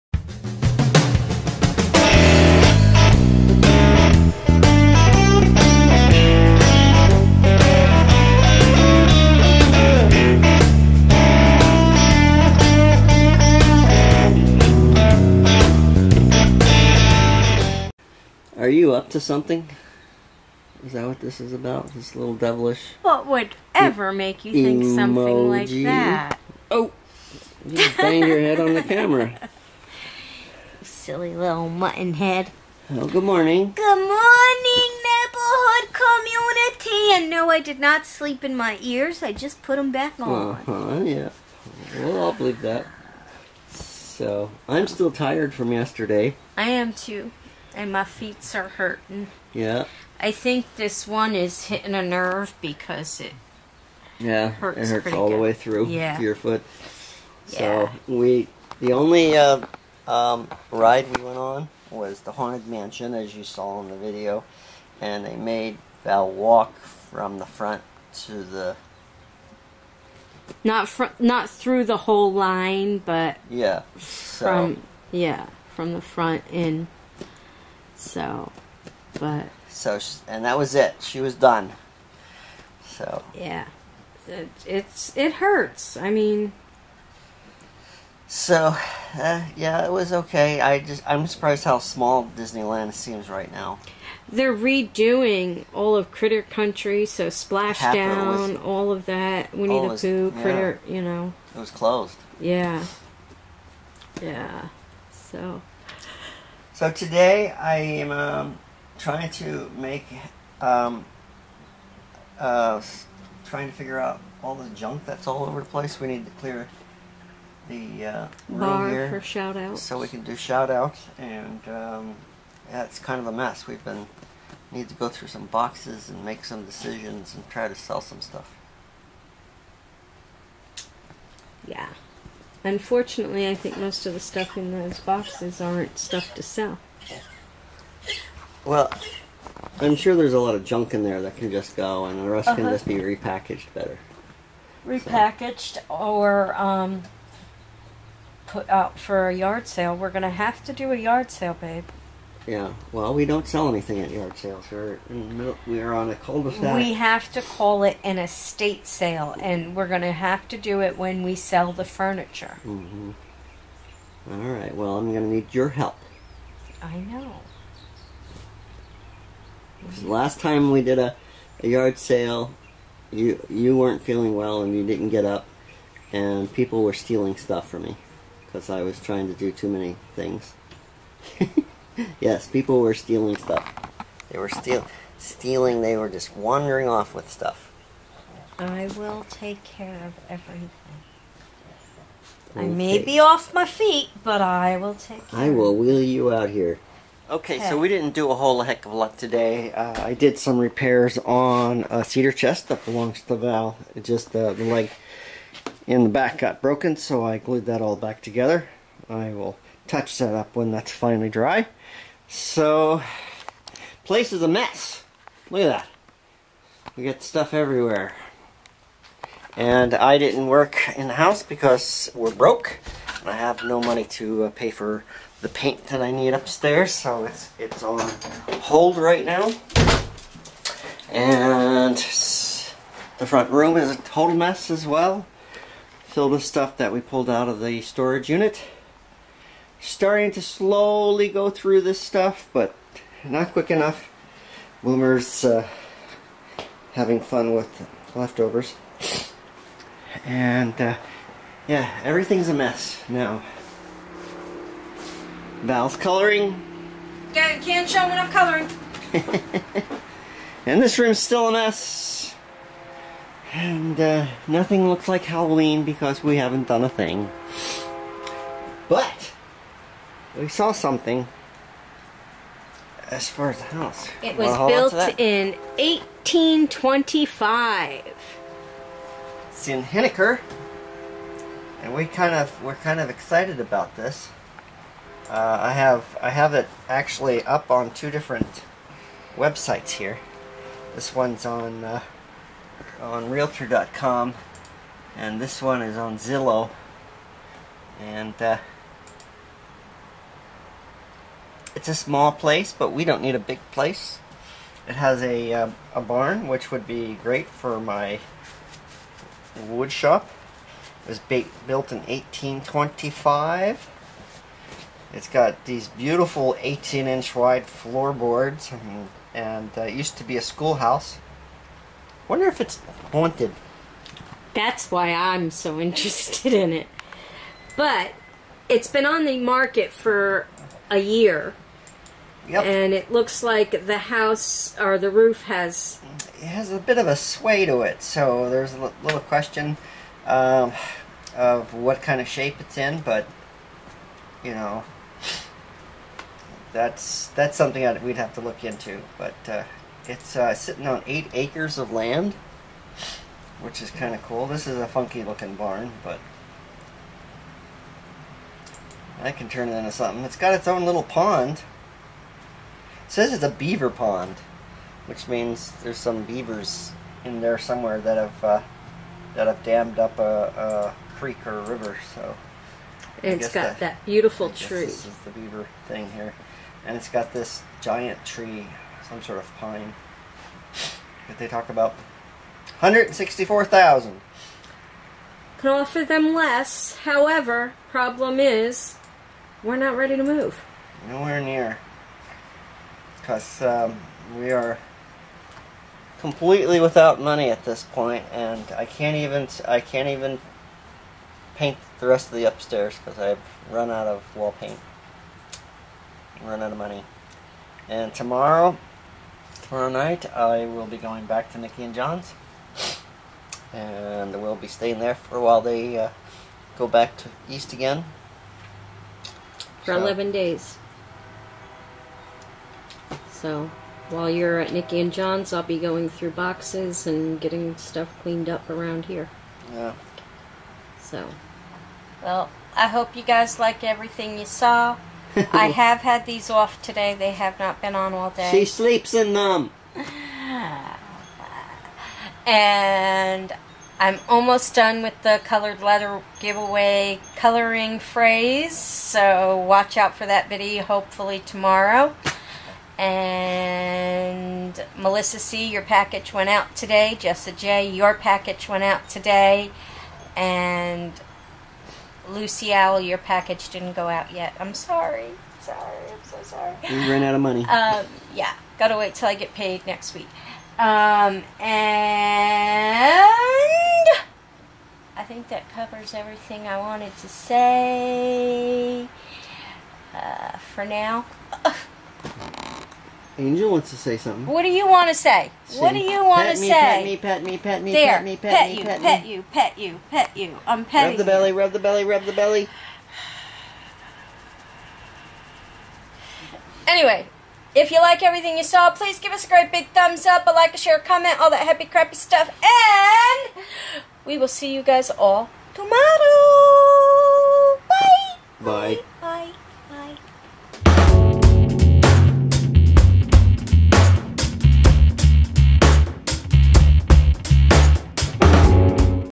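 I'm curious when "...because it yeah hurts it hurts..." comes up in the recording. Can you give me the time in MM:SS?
00:52.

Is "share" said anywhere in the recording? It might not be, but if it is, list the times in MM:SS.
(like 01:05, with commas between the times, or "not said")
08:20.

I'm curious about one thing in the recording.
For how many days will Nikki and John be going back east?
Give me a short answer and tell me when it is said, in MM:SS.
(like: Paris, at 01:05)
11, at 06:59.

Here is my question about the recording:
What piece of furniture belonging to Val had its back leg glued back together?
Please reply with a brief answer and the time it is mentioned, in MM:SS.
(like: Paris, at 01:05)
Cedar chest, at 03:22.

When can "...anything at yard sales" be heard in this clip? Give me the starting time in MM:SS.
02:33.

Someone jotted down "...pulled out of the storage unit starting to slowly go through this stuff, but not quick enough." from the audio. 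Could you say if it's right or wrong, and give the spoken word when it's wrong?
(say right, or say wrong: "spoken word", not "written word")
right.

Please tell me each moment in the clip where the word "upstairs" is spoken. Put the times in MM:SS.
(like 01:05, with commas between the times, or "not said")
03:46, 06:42.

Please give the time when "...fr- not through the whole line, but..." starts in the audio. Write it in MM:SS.
01:10.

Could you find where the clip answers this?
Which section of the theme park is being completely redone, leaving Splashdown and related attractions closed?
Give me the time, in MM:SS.
01:36.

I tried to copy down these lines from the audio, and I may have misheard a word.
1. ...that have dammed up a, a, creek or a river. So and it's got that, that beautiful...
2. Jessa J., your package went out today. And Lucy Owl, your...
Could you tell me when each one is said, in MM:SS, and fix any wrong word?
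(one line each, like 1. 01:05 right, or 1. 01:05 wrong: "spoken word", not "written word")
1. 06:09 right
2. 07:37 right.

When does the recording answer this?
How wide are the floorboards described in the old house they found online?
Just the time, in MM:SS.
05:16.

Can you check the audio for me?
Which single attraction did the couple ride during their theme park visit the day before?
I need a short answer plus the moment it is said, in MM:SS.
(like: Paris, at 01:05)
Haunted Mansion, at 01:02.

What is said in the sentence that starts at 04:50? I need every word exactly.
This one's on uh, on Realtor.com, and this one is on Zillow.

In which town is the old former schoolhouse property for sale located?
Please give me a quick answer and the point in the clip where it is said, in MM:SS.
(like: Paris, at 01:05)
Henniker, at 04:39.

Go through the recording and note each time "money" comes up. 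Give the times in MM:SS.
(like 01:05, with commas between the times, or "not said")
03:43, 06:37, 06:46, 07:47.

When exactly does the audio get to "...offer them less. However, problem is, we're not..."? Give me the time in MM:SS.
06:25.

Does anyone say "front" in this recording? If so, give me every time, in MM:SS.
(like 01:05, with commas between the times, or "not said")
01:07, 01:16, 03:53.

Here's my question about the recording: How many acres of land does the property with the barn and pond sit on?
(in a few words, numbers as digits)
8.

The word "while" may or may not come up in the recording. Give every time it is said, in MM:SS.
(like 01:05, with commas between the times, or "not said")
06:55, 07:04.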